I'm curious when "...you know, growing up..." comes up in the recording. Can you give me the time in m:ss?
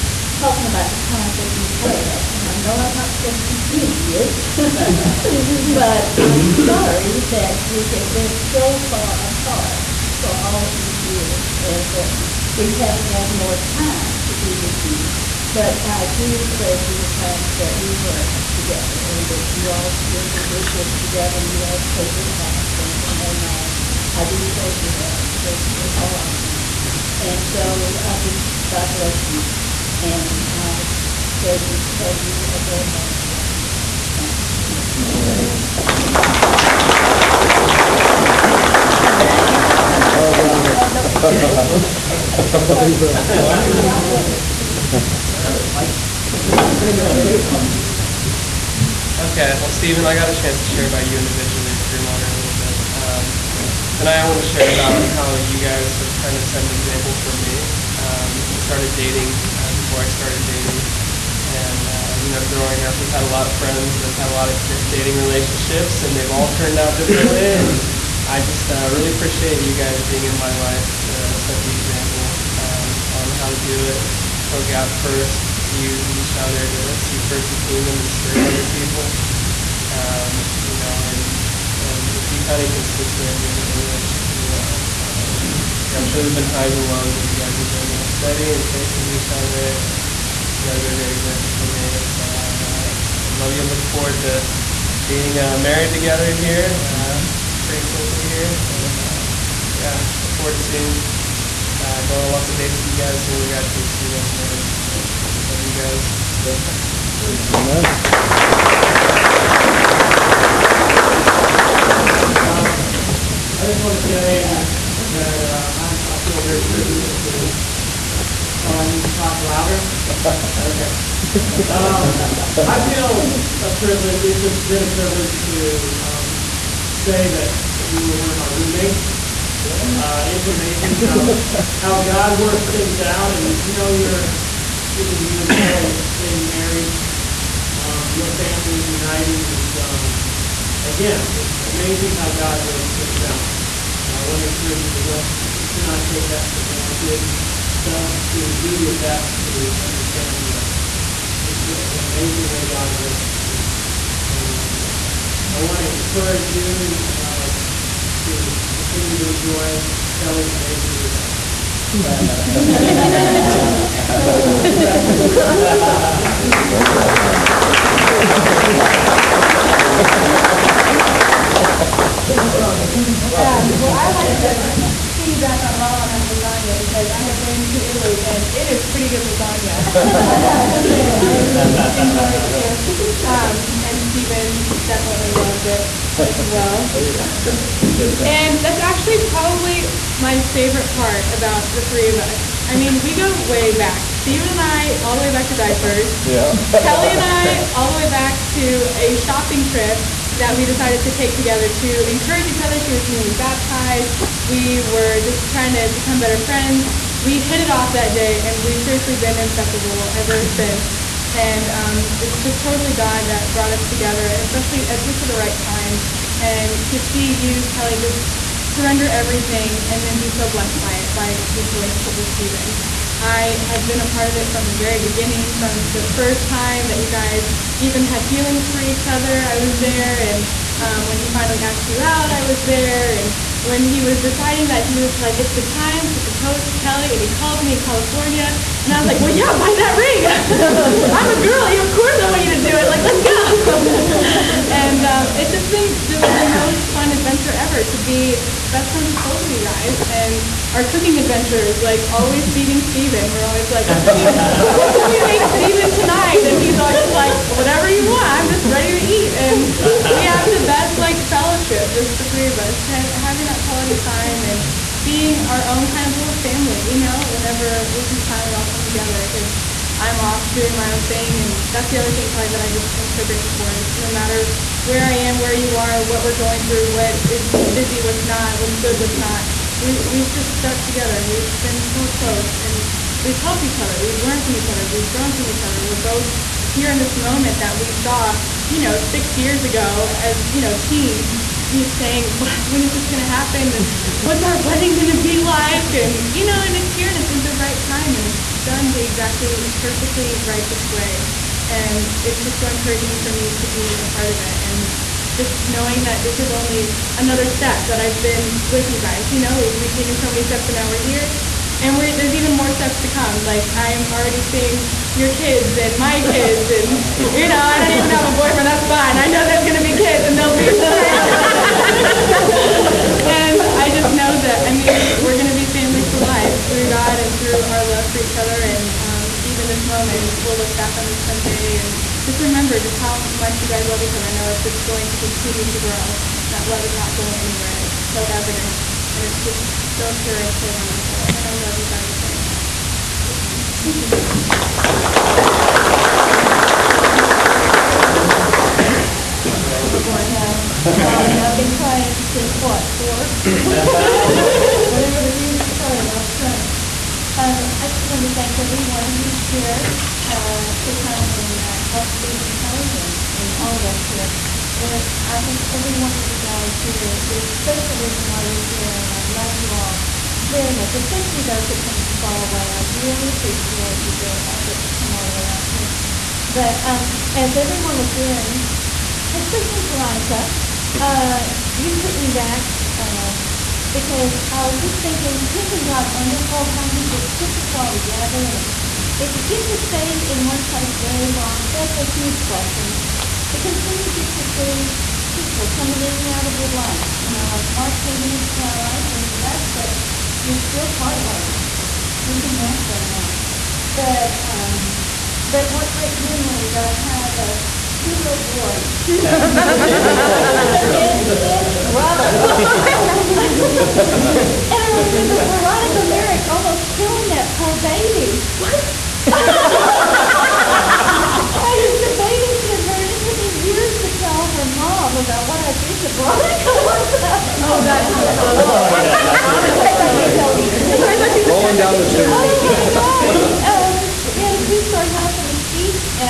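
1:02.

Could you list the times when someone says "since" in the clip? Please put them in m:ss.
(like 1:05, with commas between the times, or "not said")
3:30, 5:52.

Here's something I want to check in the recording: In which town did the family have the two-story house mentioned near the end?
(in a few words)
Mesquite.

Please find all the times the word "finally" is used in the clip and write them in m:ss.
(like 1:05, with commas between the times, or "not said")
3:51, 4:28.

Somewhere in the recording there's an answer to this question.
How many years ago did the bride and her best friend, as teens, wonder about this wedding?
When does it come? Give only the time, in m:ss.
4:49.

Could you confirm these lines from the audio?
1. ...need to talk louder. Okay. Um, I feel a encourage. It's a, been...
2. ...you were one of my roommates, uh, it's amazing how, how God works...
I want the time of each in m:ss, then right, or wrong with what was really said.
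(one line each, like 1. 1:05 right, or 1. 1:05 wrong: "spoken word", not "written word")
1. 1:58 wrong: "privilege", not "encourage"
2. 2:07 right.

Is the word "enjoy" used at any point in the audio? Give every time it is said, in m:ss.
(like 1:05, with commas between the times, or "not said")
2:39, 3:01.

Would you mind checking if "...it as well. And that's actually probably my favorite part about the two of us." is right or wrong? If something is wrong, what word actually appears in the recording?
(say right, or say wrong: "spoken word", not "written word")
wrong: "three", not "two".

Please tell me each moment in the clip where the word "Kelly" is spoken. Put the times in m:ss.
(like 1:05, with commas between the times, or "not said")
2:15, 2:40, 3:16, 3:37, 3:56, 4:32, 6:02.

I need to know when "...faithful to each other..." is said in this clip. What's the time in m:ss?
1:28.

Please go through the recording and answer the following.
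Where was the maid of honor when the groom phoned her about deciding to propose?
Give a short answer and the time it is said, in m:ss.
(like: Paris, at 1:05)
California, at 3:57.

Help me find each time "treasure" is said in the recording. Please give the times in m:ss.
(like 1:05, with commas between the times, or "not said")
0:16, 0:24, 0:31.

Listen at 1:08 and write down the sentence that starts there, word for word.
I just uh, really appreciate you guys being in my life to set the example um, on how to do it.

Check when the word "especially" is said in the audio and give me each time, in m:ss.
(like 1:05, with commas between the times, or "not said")
3:34, 6:10, 6:19.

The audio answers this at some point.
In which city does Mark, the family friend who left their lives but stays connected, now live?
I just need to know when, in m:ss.
6:42.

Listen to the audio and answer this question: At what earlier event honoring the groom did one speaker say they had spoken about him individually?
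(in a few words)
Greenwater Honor.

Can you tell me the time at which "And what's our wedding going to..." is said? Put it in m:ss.
4:53.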